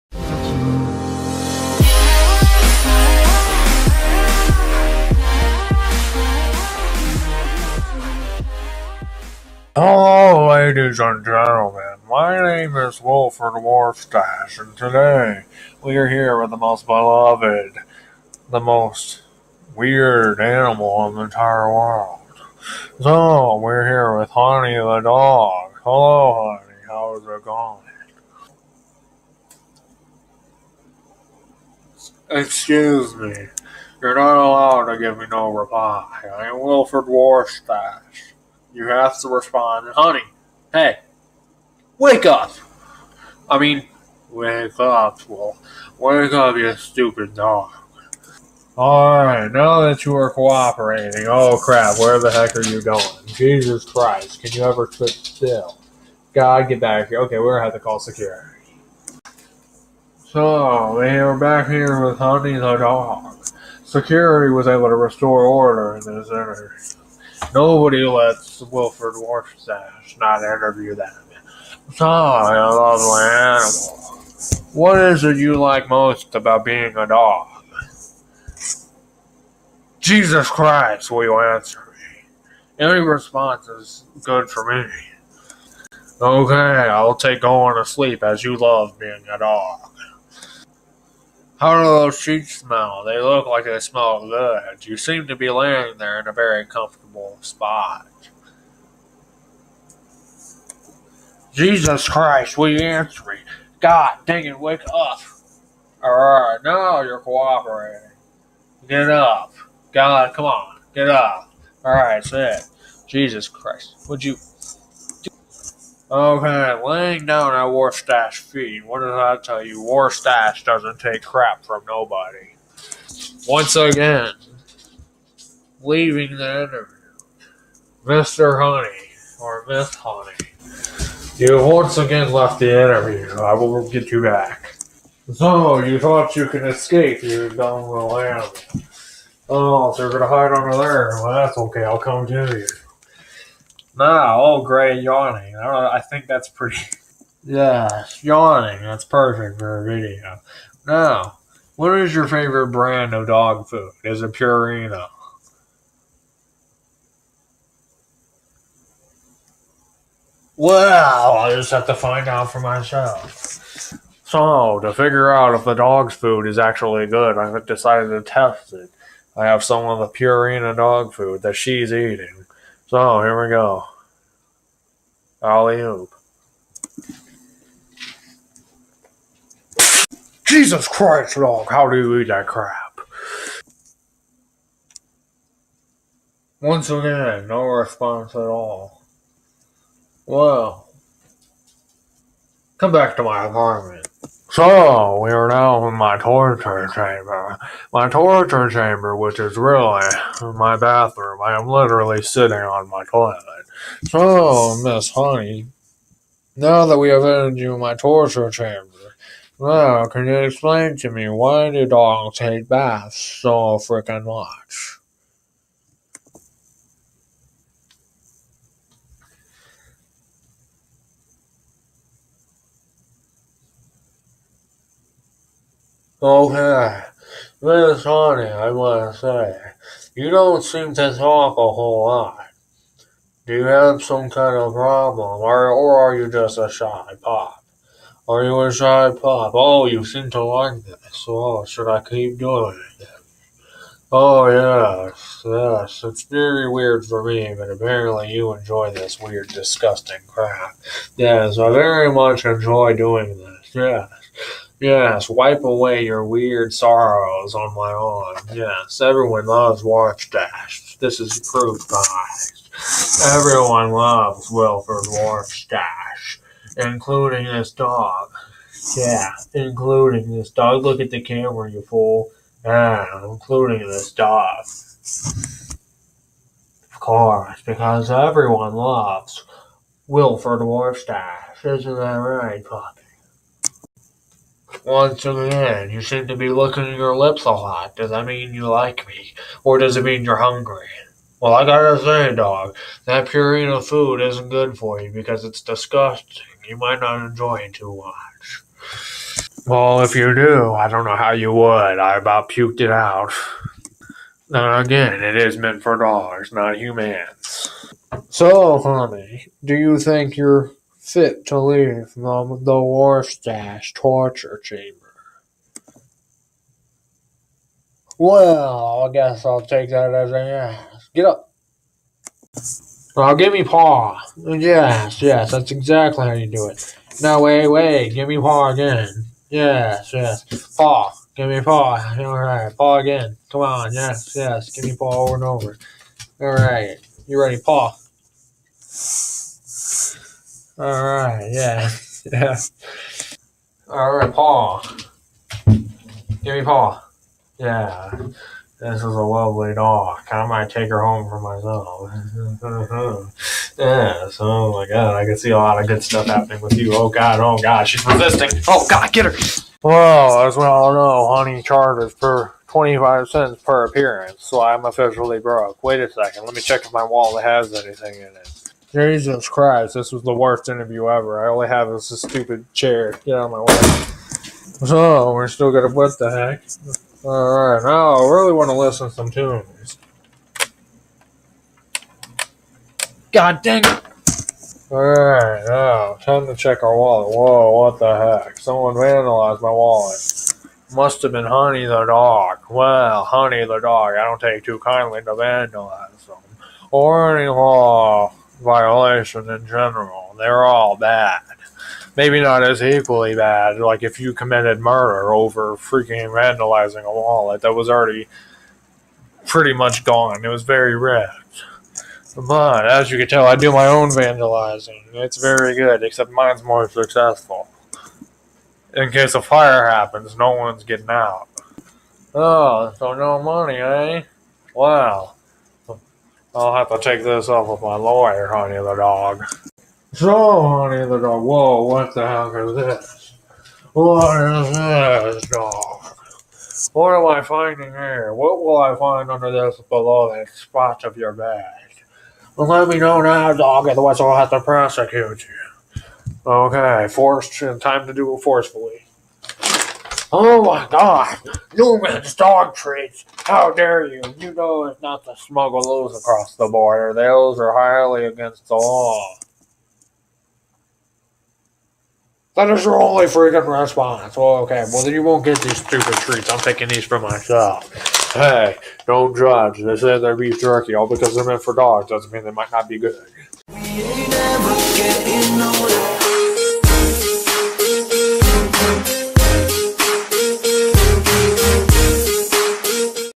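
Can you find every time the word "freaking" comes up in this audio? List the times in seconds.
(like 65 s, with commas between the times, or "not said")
213 s, 405 s, 463 s.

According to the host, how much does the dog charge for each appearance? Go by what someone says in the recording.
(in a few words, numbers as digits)
25 cents.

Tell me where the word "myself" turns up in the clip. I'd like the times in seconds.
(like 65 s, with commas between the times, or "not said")
162 s, 351 s, 467 s.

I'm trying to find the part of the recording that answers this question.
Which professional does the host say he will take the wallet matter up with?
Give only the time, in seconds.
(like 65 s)
427 s.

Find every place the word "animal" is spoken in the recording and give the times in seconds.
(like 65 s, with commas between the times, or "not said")
20 s, 73 s, 138 s.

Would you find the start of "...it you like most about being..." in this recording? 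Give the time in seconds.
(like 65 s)
75 s.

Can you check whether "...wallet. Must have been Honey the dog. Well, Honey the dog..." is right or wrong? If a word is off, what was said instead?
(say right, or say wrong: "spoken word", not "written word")
right.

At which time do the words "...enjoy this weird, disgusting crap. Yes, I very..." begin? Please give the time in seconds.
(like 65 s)
248 s.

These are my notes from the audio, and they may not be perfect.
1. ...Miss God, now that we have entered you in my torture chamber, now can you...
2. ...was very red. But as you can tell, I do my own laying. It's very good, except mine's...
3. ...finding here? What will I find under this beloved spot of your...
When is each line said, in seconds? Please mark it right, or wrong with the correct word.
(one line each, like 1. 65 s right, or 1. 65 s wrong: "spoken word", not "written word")
1. 204 s wrong: "Honey", not "God"
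2. 410 s wrong: "vandalizing", not "laying"
3. 437 s right.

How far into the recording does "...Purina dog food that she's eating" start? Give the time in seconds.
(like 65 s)
170 s.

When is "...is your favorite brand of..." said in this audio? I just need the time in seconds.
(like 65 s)
151 s.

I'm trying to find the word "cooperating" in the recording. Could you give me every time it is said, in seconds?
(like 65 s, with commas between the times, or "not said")
50 s, 107 s.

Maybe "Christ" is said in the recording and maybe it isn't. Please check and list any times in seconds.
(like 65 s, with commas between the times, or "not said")
53 s, 80 s, 102 s, 113 s, 180 s, 369 s.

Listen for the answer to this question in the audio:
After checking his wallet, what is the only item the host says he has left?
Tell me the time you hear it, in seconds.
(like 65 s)
371 s.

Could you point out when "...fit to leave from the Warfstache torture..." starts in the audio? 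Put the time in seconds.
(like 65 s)
311 s.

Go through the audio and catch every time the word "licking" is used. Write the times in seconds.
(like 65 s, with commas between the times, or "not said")
286 s.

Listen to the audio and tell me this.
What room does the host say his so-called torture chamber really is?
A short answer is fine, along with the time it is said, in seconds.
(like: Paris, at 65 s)
bathroom, at 200 s.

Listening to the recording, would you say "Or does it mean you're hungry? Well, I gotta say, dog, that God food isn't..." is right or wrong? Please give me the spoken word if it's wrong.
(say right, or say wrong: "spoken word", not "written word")
wrong: "Purina", not "God".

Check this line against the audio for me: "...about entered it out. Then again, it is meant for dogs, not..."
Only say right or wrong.
wrong.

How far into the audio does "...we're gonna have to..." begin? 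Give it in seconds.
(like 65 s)
57 s.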